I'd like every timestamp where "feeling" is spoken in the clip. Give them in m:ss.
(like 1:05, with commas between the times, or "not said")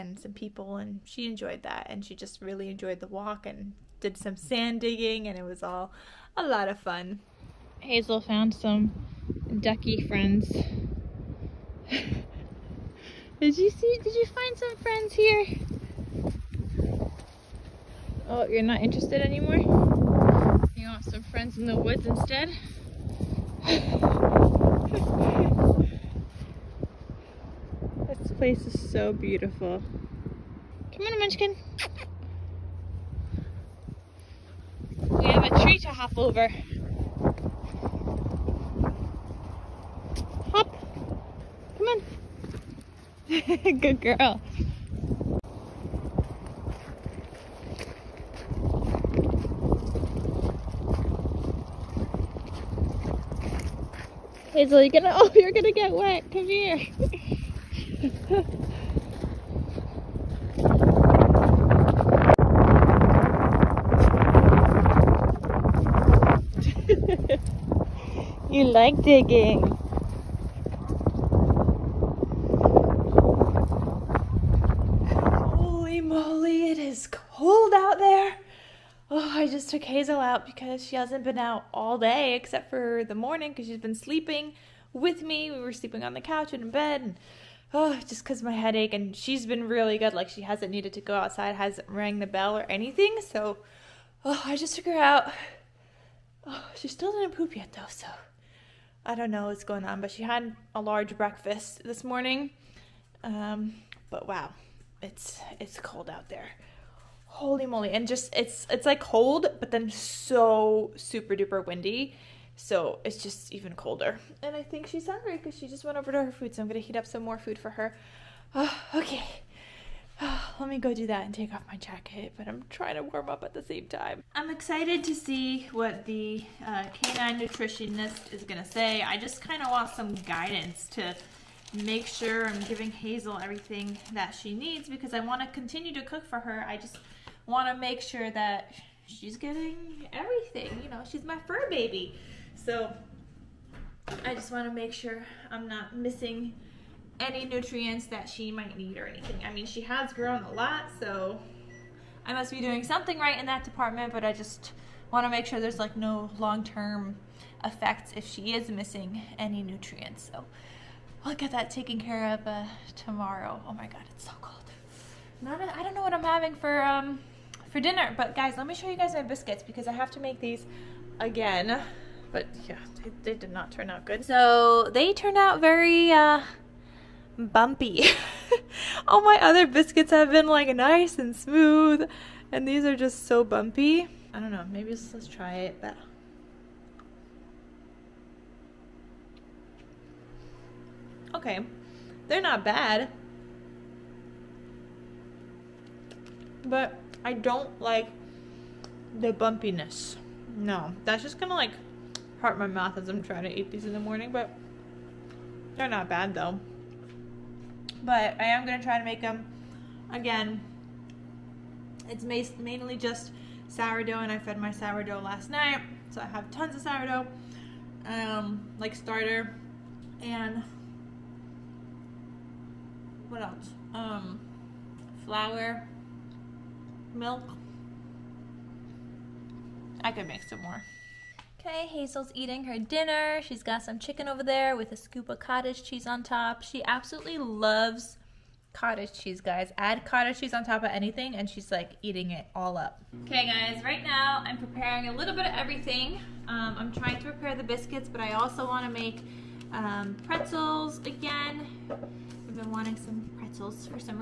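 not said.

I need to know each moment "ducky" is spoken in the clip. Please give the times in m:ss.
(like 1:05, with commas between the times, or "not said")
0:09.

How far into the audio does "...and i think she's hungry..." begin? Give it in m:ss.
1:54.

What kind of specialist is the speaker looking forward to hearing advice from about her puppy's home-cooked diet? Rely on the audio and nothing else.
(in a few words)
Canine nutritionist.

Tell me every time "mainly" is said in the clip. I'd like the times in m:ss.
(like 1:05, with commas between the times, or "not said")
3:32.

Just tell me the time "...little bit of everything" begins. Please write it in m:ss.
4:05.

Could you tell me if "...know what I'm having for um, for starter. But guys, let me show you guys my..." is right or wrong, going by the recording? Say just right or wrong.
wrong.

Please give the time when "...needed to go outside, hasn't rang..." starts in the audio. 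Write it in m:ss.
1:30.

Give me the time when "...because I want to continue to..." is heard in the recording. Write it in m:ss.
2:14.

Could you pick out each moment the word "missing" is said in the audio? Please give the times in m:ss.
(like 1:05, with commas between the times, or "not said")
2:25, 2:38.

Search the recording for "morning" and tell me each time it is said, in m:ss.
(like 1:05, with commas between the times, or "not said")
1:23, 1:42, 3:23.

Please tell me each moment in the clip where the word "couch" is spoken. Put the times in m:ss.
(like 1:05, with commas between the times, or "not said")
1:26.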